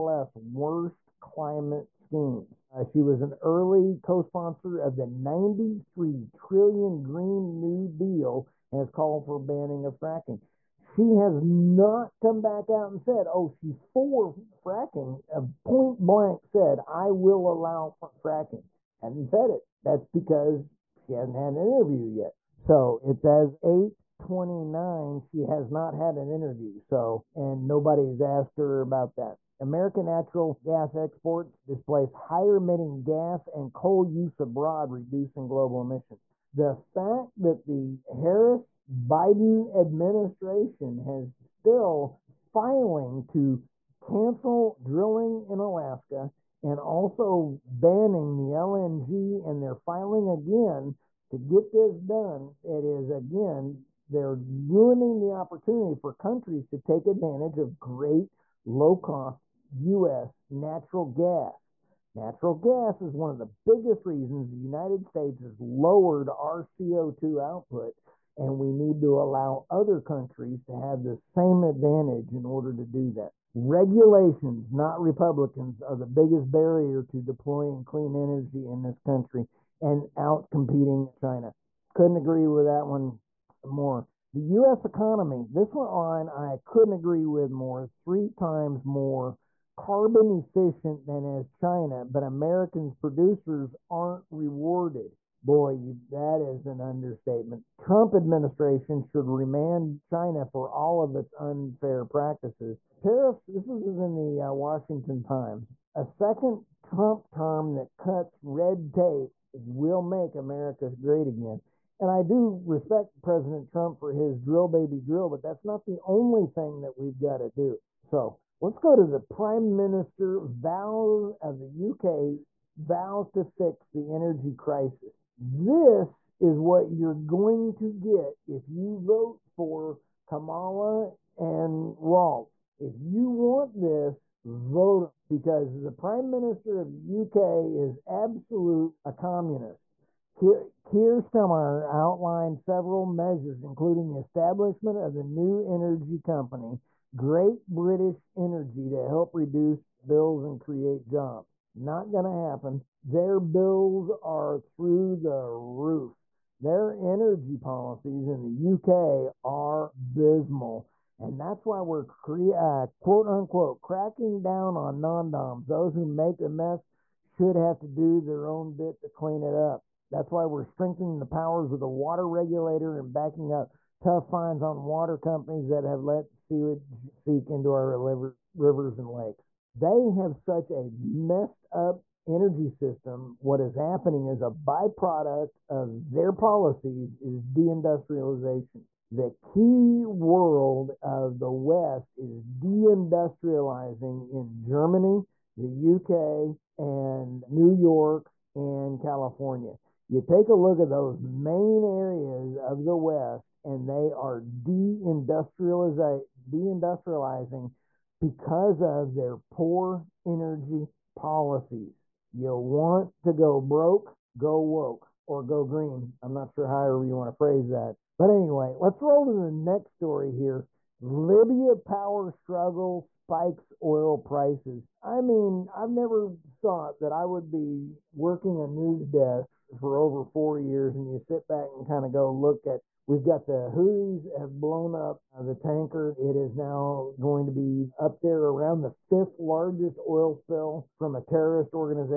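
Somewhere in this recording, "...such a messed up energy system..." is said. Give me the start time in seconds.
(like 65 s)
180 s.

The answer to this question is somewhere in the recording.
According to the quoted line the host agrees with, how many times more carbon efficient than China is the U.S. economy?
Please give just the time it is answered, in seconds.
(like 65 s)
87 s.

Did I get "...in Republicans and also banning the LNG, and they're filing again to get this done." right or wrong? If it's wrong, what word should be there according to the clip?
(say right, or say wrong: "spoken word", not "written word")
wrong: "Alaska", not "Republicans".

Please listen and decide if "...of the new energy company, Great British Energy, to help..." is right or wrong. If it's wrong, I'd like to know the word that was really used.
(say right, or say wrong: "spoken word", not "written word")
right.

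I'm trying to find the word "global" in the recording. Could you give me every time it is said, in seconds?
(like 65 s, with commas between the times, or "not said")
35 s.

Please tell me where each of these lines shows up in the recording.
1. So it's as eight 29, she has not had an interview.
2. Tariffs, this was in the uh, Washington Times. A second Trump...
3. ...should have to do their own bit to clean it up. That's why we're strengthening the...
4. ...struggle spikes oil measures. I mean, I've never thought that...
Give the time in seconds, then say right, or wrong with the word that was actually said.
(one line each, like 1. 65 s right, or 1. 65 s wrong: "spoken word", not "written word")
1. 22 s right
2. 102 s right
3. 167 s right
4. 222 s wrong: "prices", not "measures".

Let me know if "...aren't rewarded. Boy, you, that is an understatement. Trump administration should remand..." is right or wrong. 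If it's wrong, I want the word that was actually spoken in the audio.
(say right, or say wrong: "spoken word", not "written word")
right.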